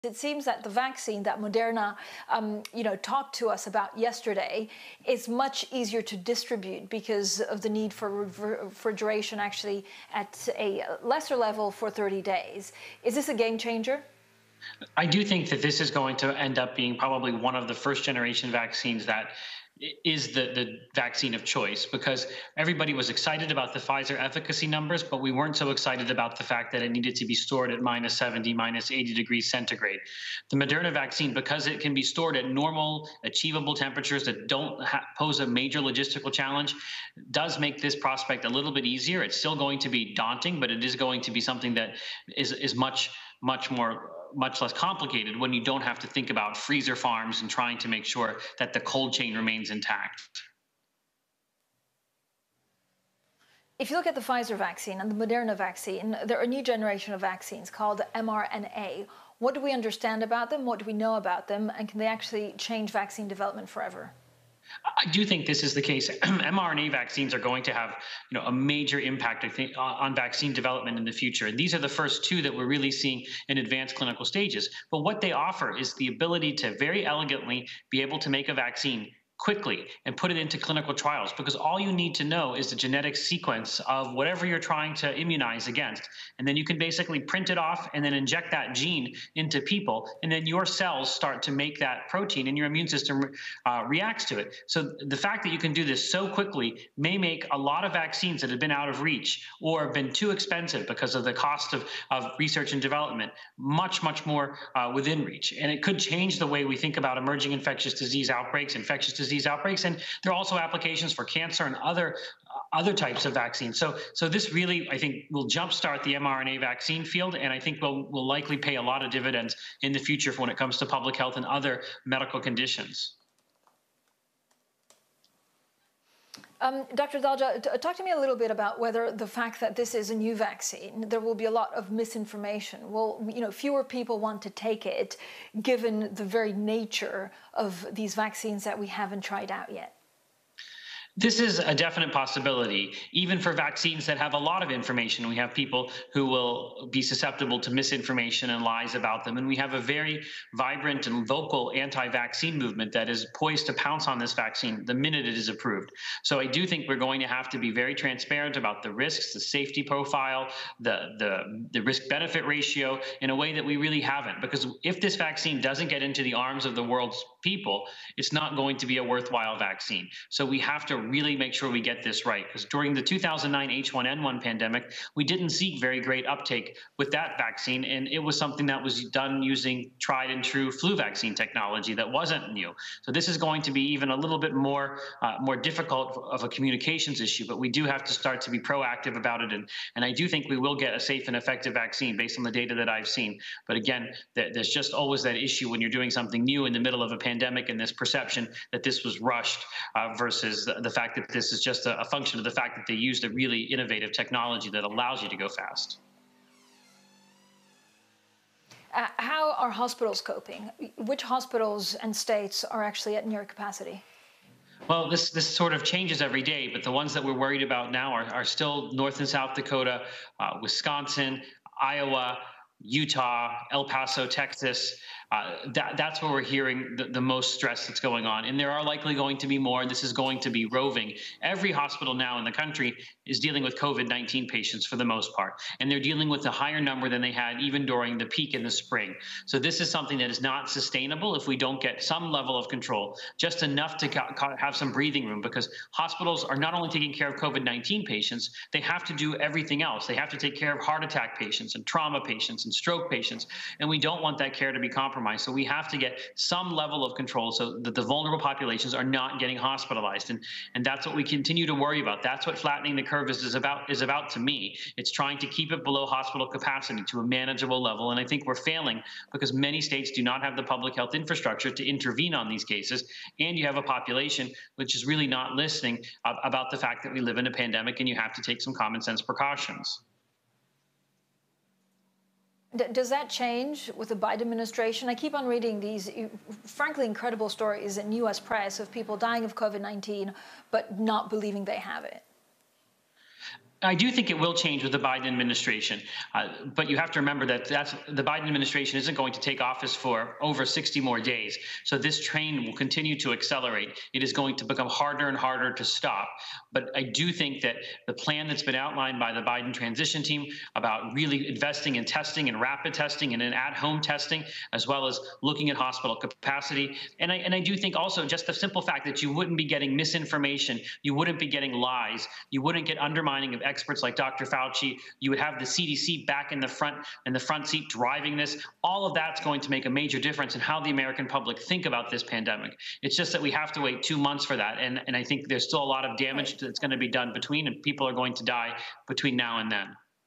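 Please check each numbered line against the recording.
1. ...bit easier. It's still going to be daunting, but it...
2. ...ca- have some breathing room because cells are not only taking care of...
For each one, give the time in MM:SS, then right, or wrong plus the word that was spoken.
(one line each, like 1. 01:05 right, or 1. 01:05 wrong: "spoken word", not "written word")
1. 00:38 right
2. 04:04 wrong: "hospitals", not "cells".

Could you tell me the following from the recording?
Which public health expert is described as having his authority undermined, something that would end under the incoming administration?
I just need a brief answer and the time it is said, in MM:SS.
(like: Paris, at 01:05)
Dr. Fauci, at 05:24.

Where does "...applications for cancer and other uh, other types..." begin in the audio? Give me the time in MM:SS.
01:50.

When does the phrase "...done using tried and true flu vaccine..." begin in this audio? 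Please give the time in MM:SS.
02:59.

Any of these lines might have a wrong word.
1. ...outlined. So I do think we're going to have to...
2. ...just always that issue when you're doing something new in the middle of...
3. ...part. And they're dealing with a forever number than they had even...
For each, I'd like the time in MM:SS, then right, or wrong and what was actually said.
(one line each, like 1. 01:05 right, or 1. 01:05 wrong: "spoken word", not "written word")
1. 02:35 wrong: "approved", not "outlined"
2. 03:14 right
3. 03:55 wrong: "higher", not "forever".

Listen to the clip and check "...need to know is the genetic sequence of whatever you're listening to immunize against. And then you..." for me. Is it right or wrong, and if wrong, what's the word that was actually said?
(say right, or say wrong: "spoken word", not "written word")
wrong: "trying", not "listening".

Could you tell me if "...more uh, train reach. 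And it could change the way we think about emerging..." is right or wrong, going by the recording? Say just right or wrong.
wrong.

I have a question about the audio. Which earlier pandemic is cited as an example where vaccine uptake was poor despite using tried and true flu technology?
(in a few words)
2009 H1N1 pandemic.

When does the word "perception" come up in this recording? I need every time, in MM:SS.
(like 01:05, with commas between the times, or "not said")
03:17.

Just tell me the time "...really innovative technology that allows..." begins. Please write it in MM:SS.
03:23.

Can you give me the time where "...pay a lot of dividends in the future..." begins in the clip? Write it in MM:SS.
01:58.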